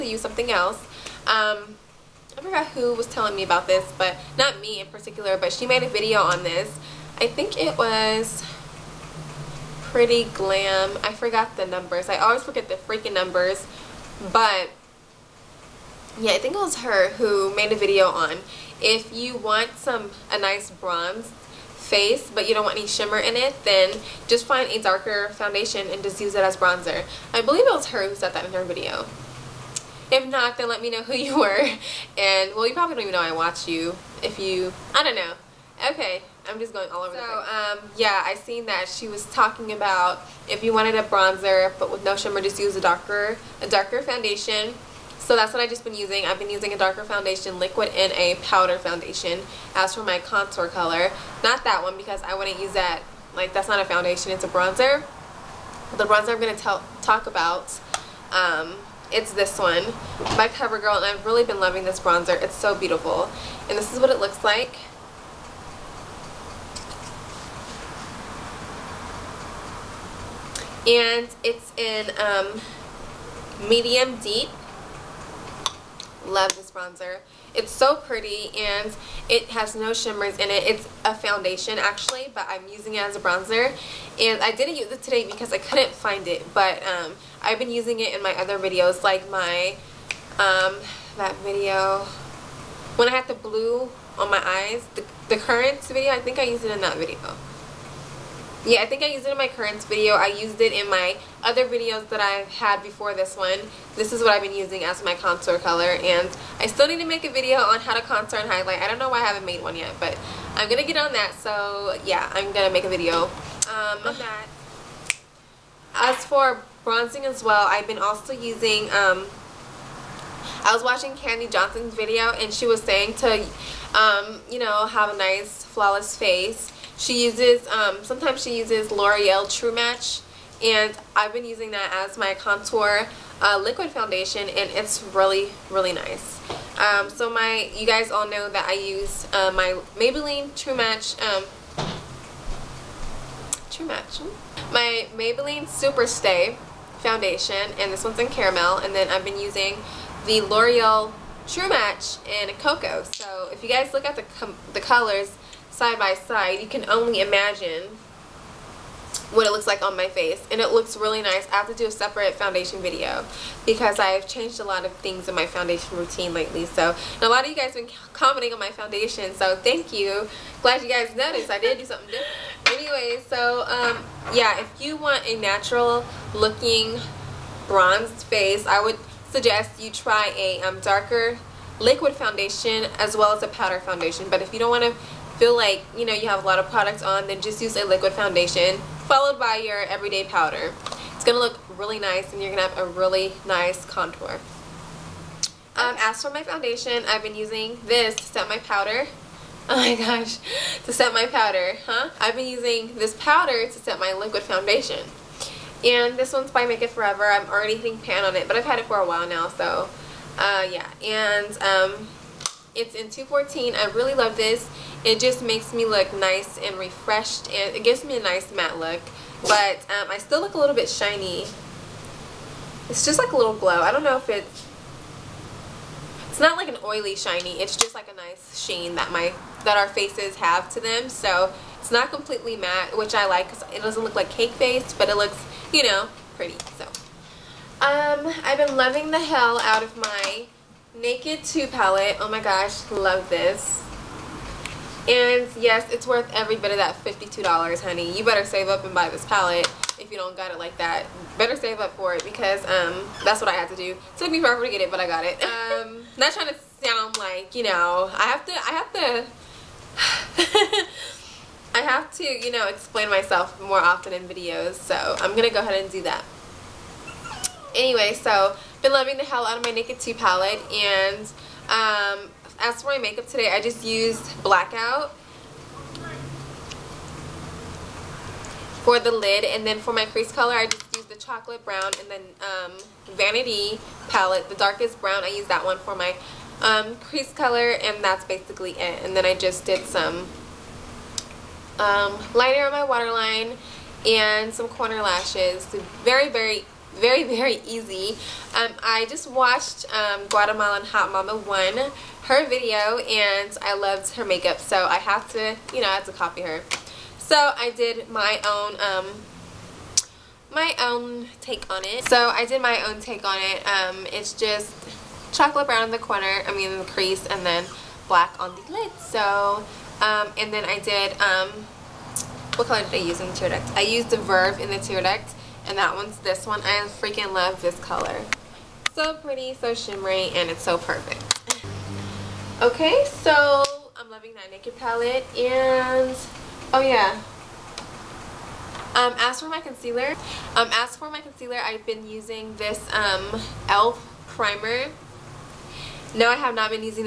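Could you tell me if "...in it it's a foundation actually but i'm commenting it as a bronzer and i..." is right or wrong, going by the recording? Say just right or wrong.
wrong.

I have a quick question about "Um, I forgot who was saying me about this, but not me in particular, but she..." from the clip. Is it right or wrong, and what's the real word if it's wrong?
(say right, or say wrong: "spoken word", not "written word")
wrong: "telling", not "saying".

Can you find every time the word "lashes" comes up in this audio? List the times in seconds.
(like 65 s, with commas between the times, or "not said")
295 s.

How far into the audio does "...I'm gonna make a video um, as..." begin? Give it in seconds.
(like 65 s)
112 s.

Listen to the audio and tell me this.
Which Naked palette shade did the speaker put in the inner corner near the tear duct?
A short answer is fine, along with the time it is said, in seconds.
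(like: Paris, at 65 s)
Verve, at 324 s.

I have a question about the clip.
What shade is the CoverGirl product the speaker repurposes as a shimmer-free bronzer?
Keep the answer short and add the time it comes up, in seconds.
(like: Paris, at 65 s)
Medium deep, at 73 s.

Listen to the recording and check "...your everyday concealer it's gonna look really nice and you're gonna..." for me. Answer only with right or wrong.
wrong.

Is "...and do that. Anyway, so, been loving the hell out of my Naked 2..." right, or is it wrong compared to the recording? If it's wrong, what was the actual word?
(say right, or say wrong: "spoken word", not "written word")
right.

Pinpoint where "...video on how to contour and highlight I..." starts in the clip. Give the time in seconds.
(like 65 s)
107 s.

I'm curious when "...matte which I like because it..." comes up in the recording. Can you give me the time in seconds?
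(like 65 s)
232 s.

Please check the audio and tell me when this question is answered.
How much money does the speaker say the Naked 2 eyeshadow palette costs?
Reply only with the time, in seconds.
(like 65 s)
246 s.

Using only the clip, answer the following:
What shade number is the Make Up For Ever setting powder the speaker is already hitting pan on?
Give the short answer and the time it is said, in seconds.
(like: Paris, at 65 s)
214, at 213 s.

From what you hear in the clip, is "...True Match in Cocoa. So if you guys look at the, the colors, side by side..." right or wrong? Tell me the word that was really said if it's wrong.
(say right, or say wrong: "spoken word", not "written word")
right.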